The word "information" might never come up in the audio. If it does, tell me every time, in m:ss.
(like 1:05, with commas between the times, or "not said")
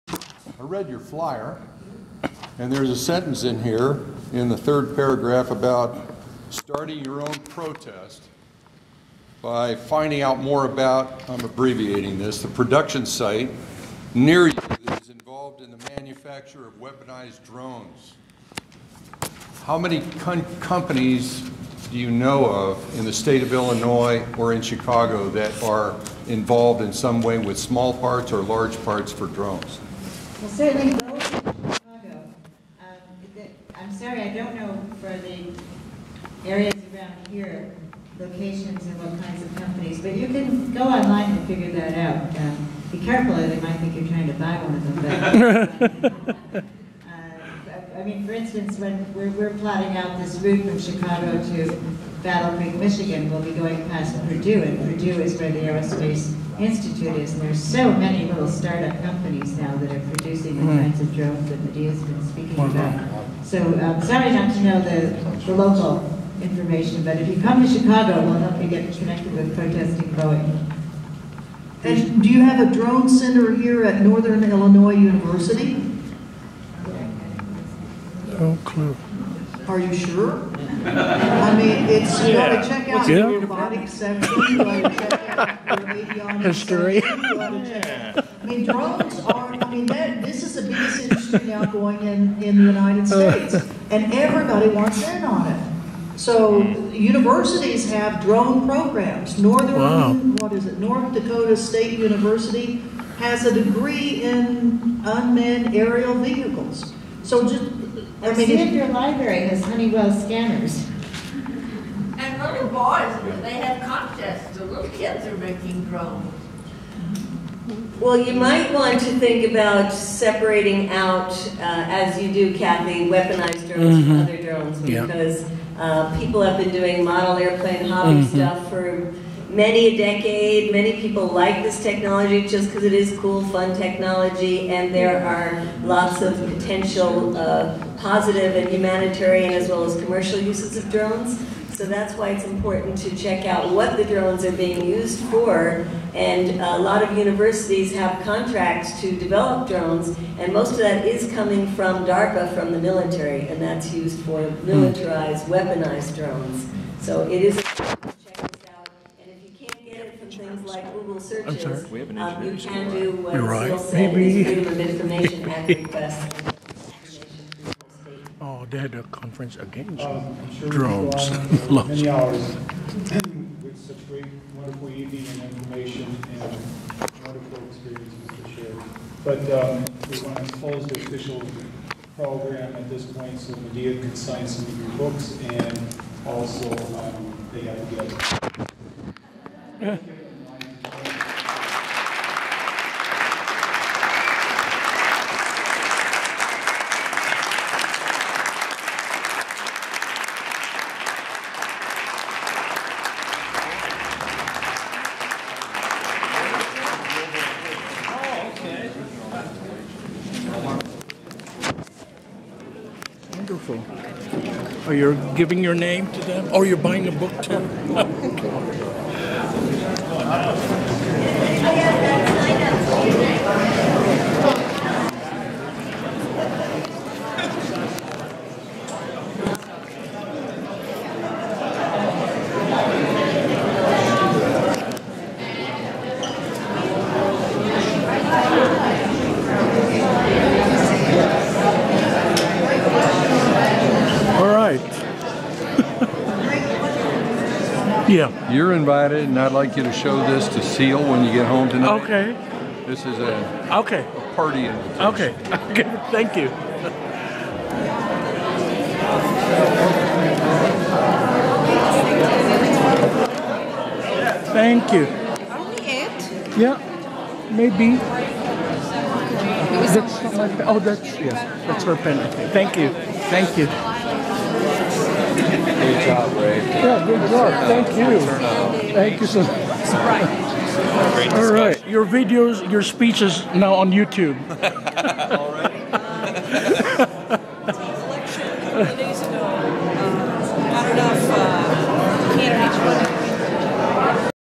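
1:06, 2:44, 2:55.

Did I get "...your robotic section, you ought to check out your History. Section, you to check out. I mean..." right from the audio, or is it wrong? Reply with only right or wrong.
right.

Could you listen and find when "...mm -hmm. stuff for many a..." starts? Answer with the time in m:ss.
2:08.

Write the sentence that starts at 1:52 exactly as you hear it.
And little boys, they have contests.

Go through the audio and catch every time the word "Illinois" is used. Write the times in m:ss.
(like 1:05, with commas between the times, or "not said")
0:23, 1:14.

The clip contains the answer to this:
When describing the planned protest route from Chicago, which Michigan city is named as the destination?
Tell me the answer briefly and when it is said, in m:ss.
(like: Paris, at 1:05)
Battle Creek, at 0:52.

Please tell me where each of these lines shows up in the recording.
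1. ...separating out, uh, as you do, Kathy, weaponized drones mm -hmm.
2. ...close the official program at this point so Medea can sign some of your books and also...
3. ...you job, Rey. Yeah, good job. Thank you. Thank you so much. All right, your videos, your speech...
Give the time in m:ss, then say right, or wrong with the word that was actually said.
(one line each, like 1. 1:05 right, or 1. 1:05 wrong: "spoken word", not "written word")
1. 1:59 right
2. 3:00 right
3. 4:33 right.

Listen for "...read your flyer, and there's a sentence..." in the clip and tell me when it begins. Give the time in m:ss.
0:00.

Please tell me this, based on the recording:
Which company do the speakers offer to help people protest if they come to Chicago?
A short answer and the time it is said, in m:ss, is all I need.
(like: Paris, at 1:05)
Boeing, at 1:10.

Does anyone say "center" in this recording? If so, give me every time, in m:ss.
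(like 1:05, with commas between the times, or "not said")
1:13.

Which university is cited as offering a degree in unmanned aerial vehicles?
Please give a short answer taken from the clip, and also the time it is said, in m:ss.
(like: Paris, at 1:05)
North Dakota State University, at 1:40.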